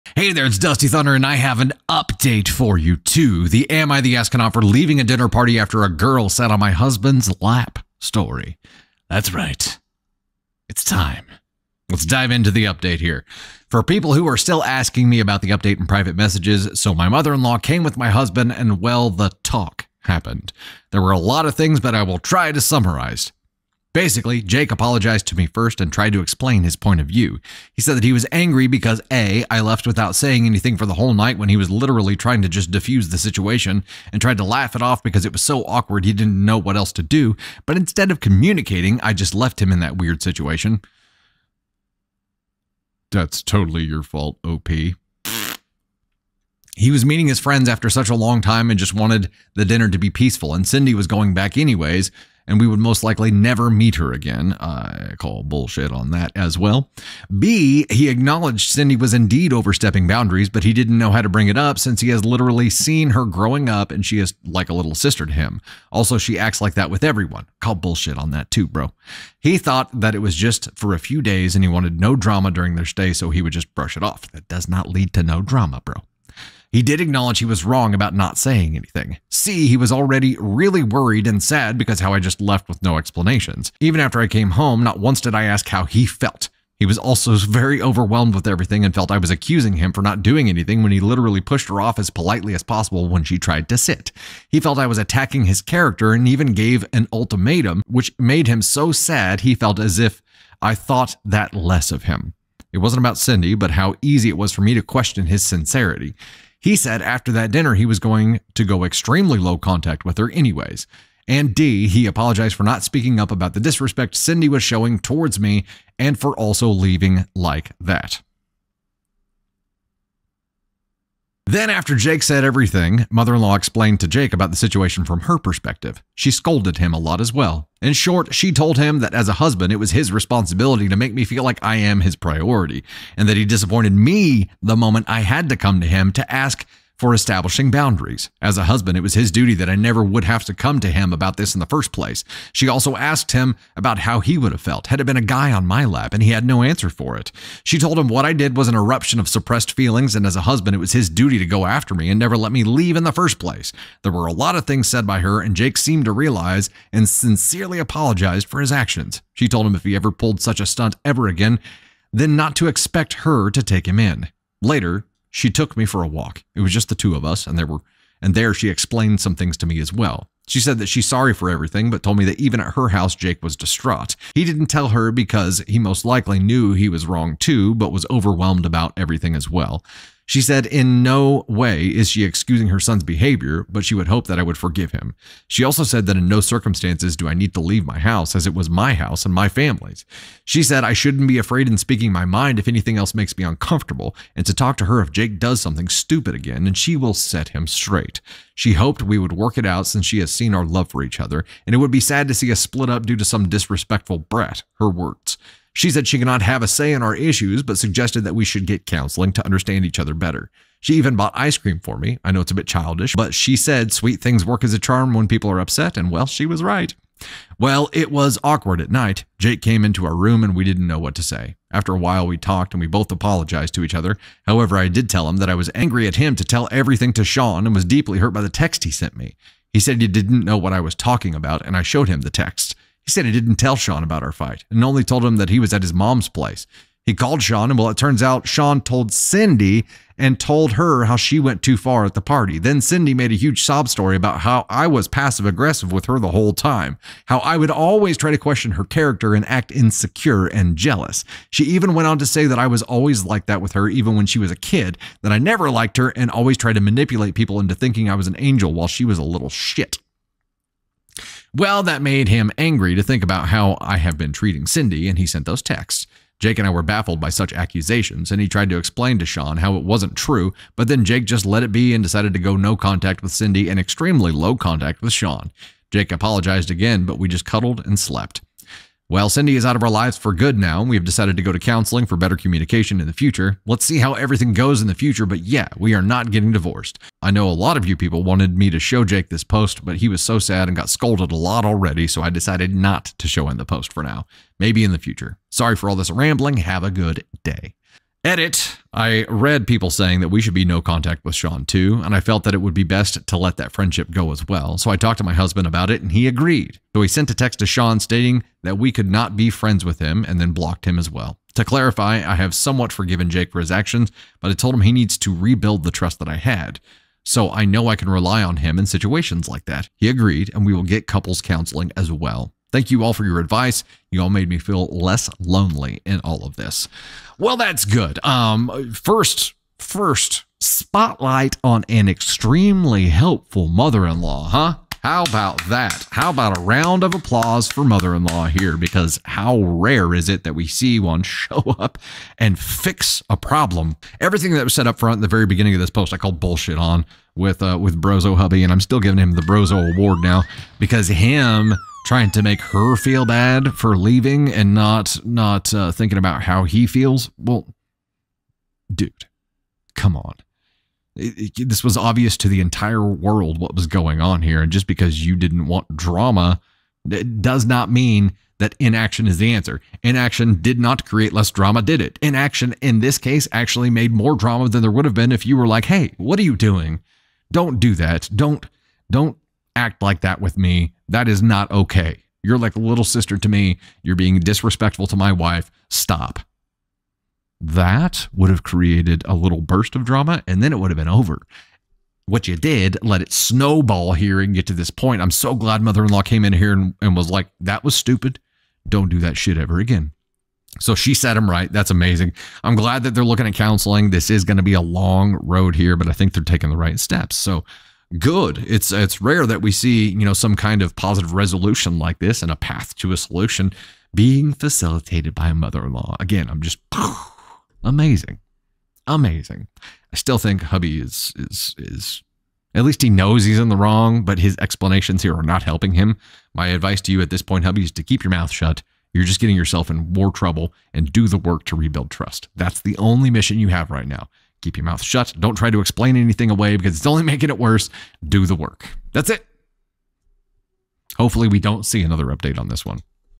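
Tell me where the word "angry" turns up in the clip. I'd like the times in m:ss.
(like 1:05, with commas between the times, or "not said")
0:28, 3:45, 4:22.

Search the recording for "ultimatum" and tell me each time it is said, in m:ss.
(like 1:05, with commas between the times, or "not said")
1:37.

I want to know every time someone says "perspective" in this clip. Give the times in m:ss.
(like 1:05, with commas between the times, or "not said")
2:05.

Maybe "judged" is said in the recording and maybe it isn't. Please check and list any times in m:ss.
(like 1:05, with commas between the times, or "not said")
not said.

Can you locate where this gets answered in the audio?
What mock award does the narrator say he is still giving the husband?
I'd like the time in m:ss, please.
5:49.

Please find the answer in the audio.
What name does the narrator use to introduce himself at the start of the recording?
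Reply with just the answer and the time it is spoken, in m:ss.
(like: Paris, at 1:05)
Dusty Thunder, at 0:00.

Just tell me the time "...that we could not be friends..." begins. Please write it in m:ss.
5:08.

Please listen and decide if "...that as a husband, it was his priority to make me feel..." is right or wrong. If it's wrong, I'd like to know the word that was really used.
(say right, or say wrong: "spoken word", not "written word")
wrong: "responsibility", not "priority".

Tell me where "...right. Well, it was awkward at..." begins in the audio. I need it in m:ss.
3:36.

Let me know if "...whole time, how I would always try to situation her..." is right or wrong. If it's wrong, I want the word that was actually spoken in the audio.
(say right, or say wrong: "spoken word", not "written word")
wrong: "question", not "situation".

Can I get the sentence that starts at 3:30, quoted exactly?
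She even bought ice cream for me.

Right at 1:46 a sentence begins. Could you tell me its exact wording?
He said after that dinner, he was going to go extremely low contact with her, anyways.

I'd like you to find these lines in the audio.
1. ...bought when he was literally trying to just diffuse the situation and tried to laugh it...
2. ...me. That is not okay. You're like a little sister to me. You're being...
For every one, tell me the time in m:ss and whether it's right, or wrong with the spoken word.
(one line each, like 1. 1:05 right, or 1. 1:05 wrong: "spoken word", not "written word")
1. 0:31 wrong: "night", not "bought"
2. 6:20 right.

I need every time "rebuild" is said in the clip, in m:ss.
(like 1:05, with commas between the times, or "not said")
5:15, 7:11.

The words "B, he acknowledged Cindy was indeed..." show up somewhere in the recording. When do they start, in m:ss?
0:57.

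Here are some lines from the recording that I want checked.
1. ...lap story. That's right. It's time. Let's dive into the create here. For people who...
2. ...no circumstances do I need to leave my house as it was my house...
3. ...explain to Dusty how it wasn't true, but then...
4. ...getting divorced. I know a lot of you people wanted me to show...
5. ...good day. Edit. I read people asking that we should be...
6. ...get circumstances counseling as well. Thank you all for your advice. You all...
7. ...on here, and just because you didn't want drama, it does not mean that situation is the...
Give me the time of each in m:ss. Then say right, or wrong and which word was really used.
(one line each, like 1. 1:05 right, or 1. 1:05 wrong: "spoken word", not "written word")
1. 0:07 wrong: "update", not "create"
2. 3:06 right
3. 4:28 wrong: "Sean", not "Dusty"
4. 4:46 right
5. 4:56 wrong: "saying", not "asking"
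6. 5:20 wrong: "couples", not "circumstances"
7. 6:04 wrong: "inaction", not "situation".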